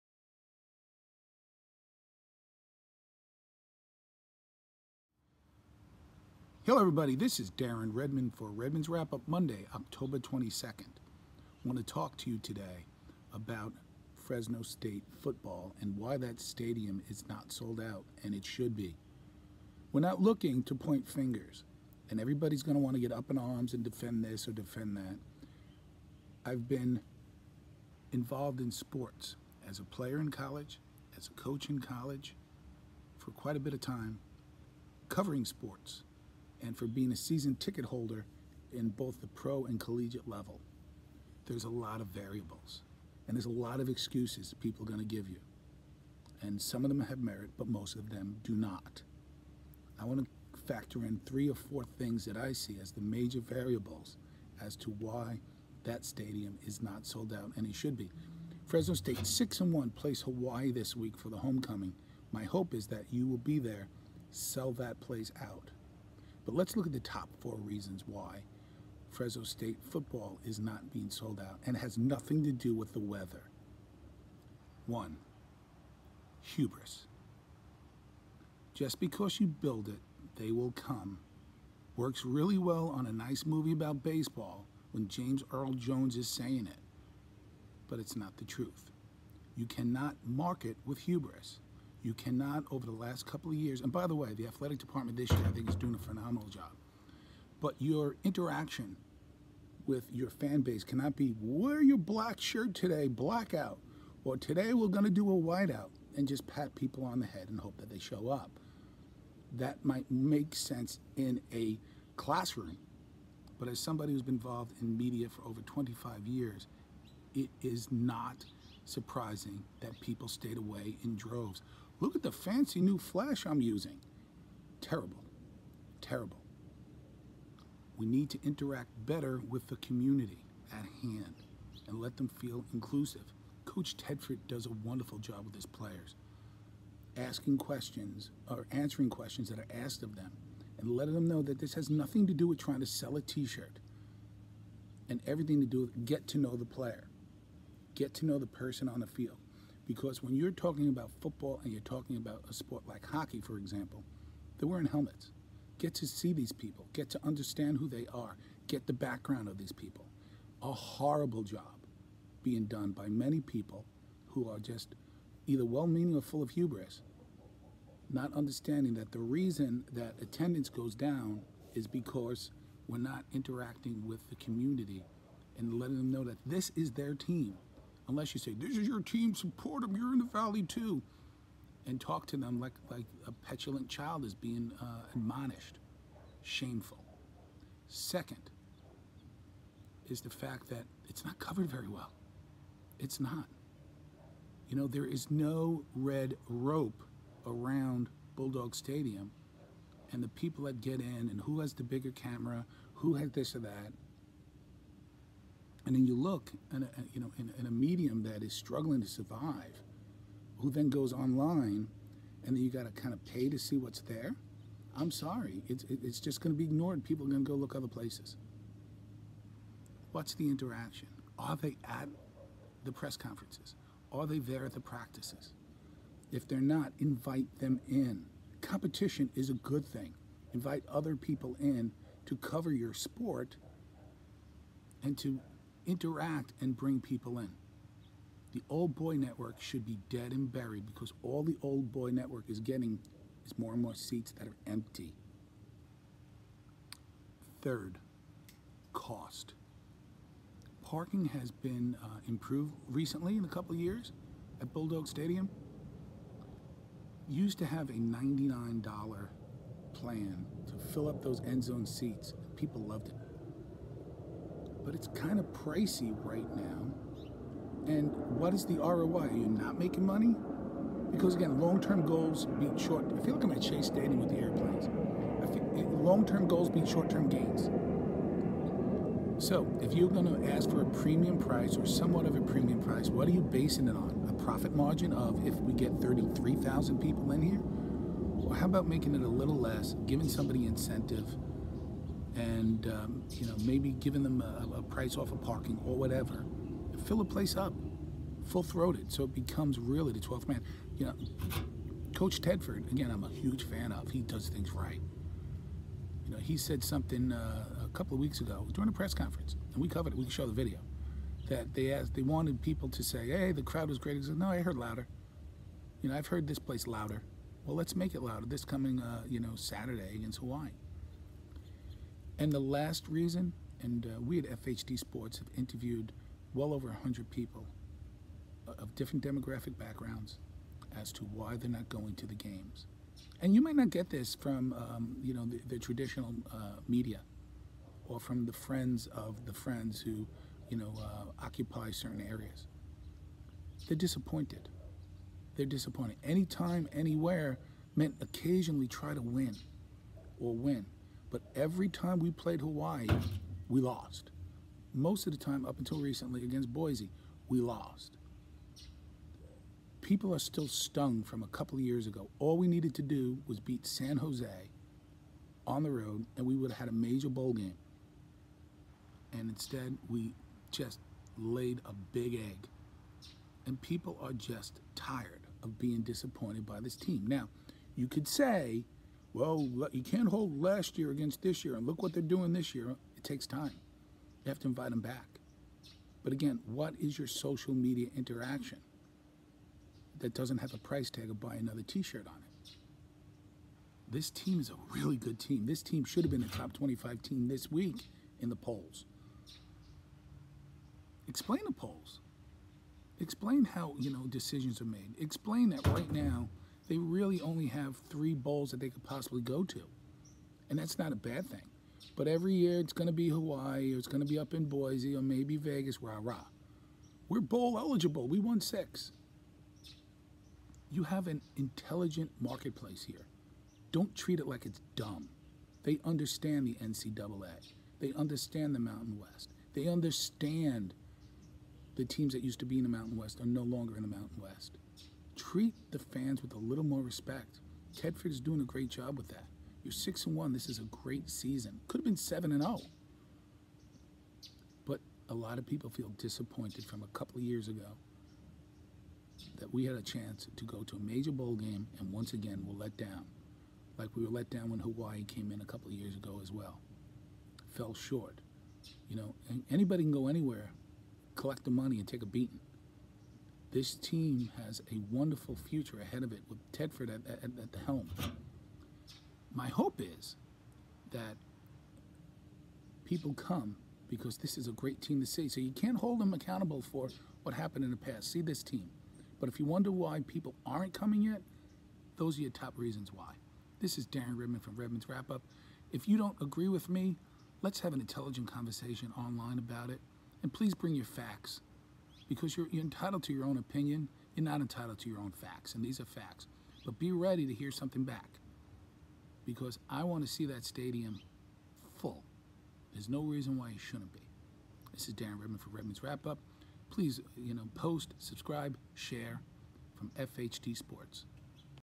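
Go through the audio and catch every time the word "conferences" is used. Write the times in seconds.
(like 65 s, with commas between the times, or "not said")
223 s, 309 s.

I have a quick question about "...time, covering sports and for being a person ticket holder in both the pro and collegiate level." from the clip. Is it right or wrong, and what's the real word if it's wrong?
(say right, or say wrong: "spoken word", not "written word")
wrong: "season", not "person".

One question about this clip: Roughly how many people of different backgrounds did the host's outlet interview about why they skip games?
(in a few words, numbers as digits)
over 100.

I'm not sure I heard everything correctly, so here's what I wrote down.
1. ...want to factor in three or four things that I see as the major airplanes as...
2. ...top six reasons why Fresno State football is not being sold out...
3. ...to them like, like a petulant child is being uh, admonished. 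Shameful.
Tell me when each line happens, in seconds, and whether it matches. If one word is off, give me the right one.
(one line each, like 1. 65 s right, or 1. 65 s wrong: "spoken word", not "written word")
1. 50 s wrong: "variables", not "airplanes"
2. 66 s wrong: "four", not "six"
3. 182 s right.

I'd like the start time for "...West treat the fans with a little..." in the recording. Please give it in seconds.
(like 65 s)
434 s.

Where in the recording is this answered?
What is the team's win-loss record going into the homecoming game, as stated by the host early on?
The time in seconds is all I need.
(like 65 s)
59 s.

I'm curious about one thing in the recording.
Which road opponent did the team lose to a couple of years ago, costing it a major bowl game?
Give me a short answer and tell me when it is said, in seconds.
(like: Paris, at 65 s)
San Jose, at 363 s.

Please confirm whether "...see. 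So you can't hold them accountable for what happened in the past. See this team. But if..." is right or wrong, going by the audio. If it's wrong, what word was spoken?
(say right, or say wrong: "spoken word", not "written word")
right.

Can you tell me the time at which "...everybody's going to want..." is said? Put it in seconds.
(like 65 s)
22 s.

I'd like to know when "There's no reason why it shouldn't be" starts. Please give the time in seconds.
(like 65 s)
502 s.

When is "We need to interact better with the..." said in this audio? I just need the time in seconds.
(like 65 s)
127 s.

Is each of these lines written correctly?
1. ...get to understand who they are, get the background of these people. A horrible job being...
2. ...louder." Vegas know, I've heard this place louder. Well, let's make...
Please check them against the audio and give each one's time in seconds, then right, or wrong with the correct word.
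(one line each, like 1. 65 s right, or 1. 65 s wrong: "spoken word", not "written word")
1. 156 s right
2. 314 s wrong: "You", not "Vegas".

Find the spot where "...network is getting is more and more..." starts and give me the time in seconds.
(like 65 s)
242 s.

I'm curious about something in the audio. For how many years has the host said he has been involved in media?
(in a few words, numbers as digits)
25.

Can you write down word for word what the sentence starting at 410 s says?
And that's not a bad thing.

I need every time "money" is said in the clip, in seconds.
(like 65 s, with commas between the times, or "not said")
270 s, 461 s.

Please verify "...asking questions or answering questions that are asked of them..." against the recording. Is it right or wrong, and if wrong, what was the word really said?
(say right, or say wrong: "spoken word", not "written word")
right.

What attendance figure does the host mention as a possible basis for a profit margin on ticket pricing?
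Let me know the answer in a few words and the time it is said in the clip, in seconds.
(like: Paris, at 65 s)
33,000, at 285 s.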